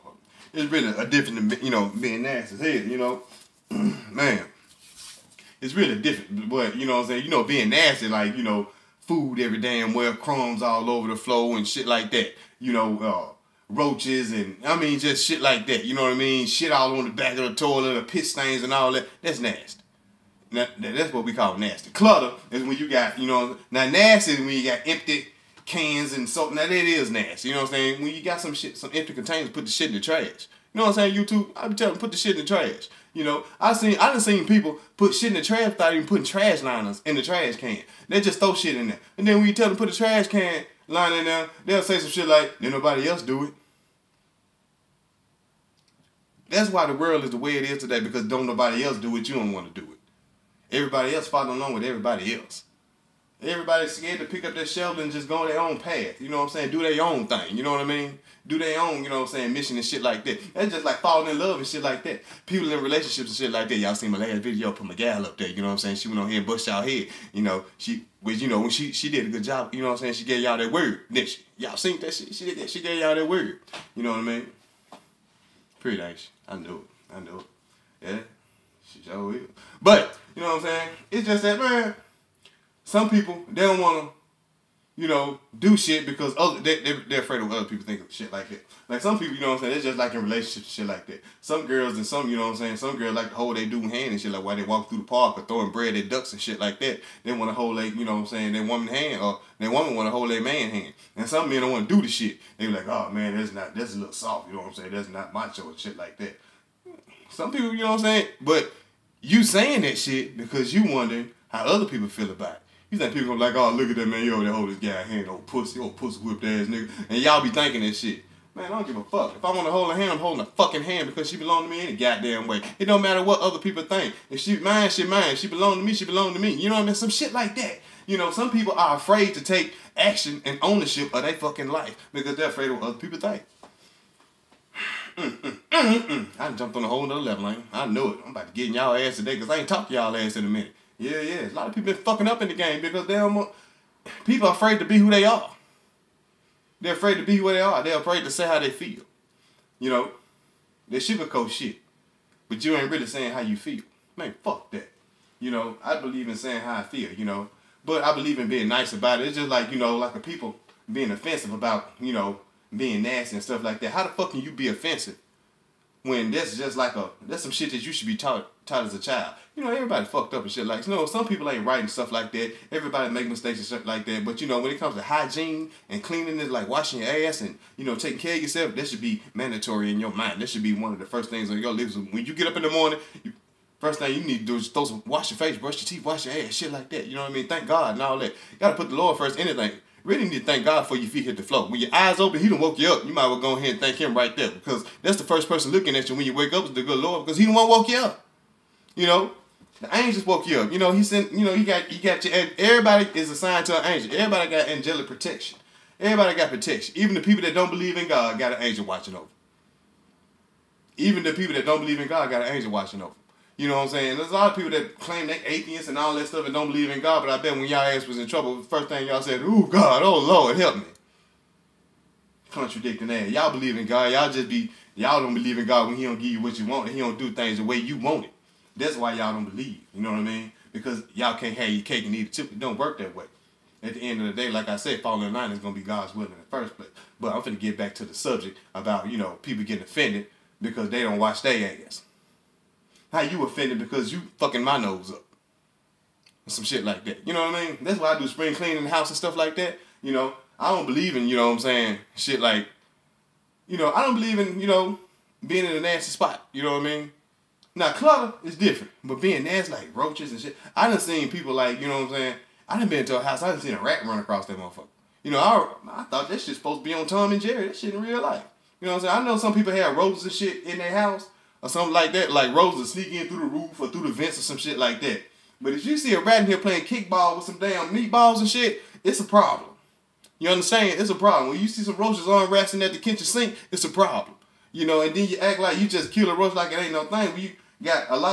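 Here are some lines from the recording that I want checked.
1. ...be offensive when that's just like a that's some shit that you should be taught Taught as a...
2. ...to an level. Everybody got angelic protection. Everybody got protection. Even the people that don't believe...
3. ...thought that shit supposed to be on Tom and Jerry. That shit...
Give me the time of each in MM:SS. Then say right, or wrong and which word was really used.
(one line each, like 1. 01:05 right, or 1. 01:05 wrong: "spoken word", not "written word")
1. 02:44 right
2. 03:23 wrong: "angel", not "level"
3. 04:26 right.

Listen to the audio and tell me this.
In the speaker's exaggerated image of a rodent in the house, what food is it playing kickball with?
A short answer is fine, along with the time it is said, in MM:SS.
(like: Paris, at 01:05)
meatballs, at 04:37.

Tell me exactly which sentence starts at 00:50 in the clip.
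Everybody else following along with everybody else.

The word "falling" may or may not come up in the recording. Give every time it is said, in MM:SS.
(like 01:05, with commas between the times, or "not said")
01:00, 03:55.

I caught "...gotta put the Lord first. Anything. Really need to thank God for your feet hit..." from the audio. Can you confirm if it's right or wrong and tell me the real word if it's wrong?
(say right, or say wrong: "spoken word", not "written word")
right.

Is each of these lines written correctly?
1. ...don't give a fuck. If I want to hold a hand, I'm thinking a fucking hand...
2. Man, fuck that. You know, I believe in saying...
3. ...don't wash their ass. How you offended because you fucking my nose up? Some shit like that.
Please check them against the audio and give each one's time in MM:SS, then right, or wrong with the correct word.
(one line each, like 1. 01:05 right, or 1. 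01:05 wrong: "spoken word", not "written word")
1. 01:58 wrong: "holding", not "thinking"
2. 02:34 right
3. 04:01 right.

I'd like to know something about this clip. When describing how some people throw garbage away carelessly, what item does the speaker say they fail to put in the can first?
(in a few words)
trash liners.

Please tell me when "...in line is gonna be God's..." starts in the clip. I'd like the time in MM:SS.
03:55.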